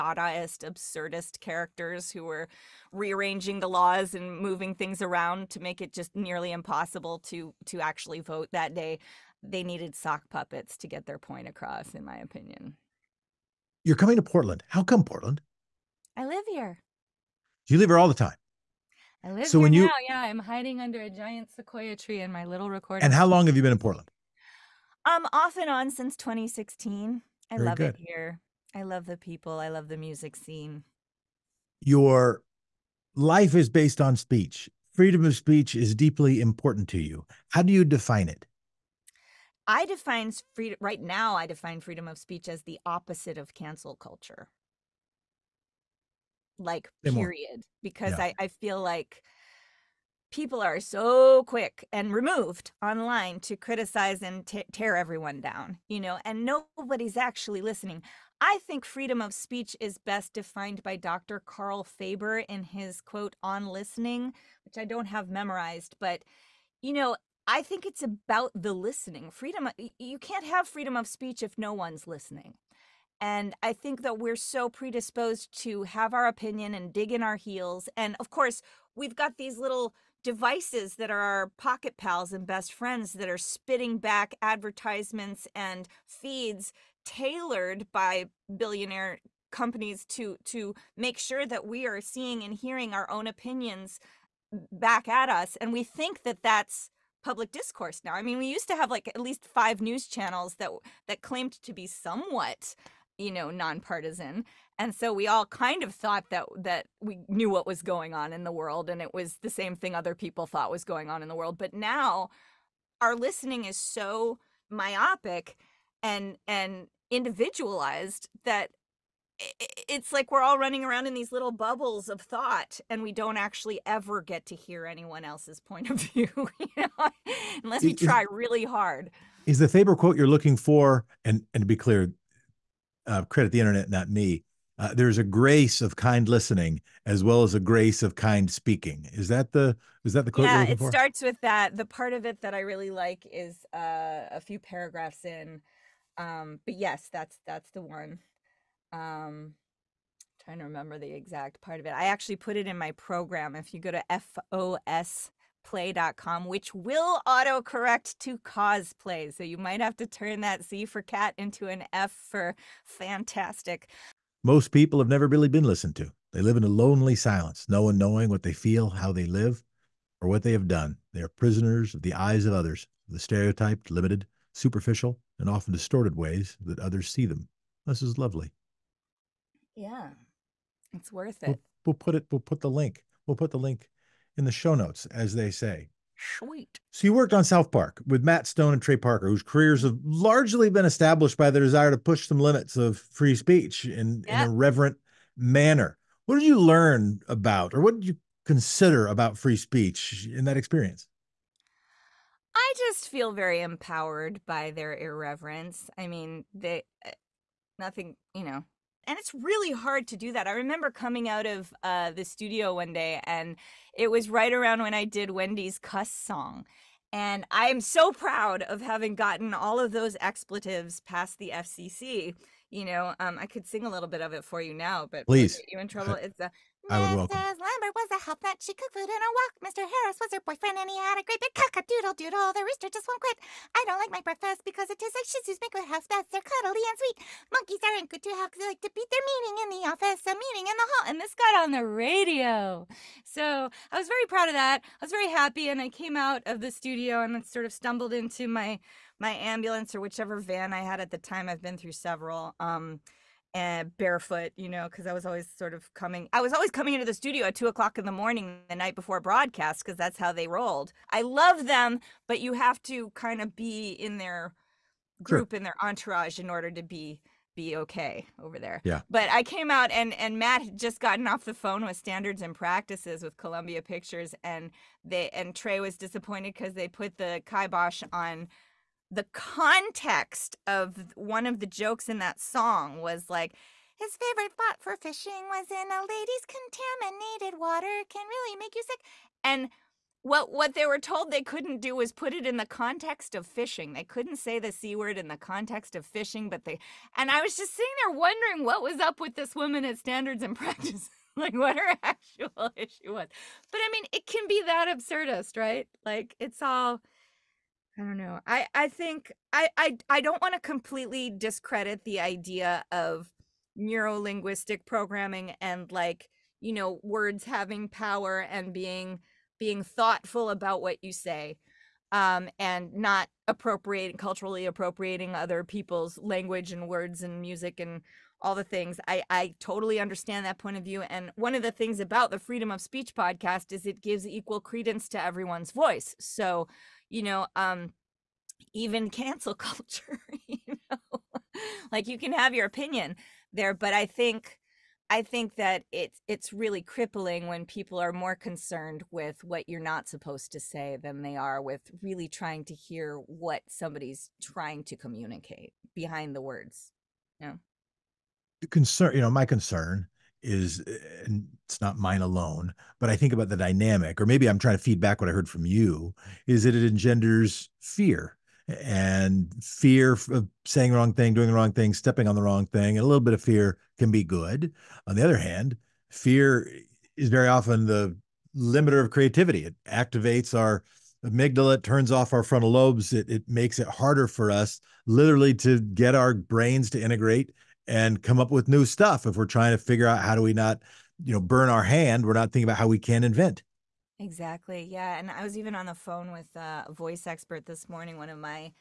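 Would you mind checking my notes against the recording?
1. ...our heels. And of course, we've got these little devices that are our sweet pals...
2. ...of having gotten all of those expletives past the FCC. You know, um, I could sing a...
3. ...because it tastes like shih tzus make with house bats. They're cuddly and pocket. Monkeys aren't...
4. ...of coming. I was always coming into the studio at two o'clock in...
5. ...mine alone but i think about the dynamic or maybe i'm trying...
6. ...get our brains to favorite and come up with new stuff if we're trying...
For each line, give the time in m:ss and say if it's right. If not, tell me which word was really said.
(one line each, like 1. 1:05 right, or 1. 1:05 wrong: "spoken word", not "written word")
1. 1:17 wrong: "pocket", not "sweet"
2. 3:38 right
3. 3:54 wrong: "sweet", not "pocket"
4. 4:15 right
5. 6:01 right
6. 6:25 wrong: "integrate", not "favorite".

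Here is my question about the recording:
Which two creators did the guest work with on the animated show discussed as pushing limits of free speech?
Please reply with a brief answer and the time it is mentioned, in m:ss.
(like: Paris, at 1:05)
Matt Stone and Trey Parker, at 3:08.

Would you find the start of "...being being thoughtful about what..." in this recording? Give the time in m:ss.
5:18.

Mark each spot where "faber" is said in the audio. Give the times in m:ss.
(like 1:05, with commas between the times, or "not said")
1:01, 2:09.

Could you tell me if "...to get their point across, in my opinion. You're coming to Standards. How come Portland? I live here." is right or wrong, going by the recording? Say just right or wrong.
wrong.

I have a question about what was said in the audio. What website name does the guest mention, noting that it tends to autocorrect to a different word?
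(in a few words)
fosplay.com.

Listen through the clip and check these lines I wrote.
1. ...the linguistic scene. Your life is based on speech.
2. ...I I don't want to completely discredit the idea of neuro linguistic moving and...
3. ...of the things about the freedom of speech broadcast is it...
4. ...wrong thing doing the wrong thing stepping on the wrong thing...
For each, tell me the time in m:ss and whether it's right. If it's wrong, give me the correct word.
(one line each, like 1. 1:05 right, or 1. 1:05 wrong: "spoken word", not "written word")
1. 0:29 wrong: "music", not "linguistic"
2. 5:09 wrong: "programming", not "moving"
3. 5:31 wrong: "podcast", not "broadcast"
4. 6:10 right.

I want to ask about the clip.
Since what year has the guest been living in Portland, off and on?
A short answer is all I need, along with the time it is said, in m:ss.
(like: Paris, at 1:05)
2016, at 0:26.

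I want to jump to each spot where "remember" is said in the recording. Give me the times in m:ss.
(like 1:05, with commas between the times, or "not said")
2:30, 3:30.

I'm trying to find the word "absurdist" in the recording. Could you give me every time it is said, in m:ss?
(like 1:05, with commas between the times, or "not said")
0:00, 5:04.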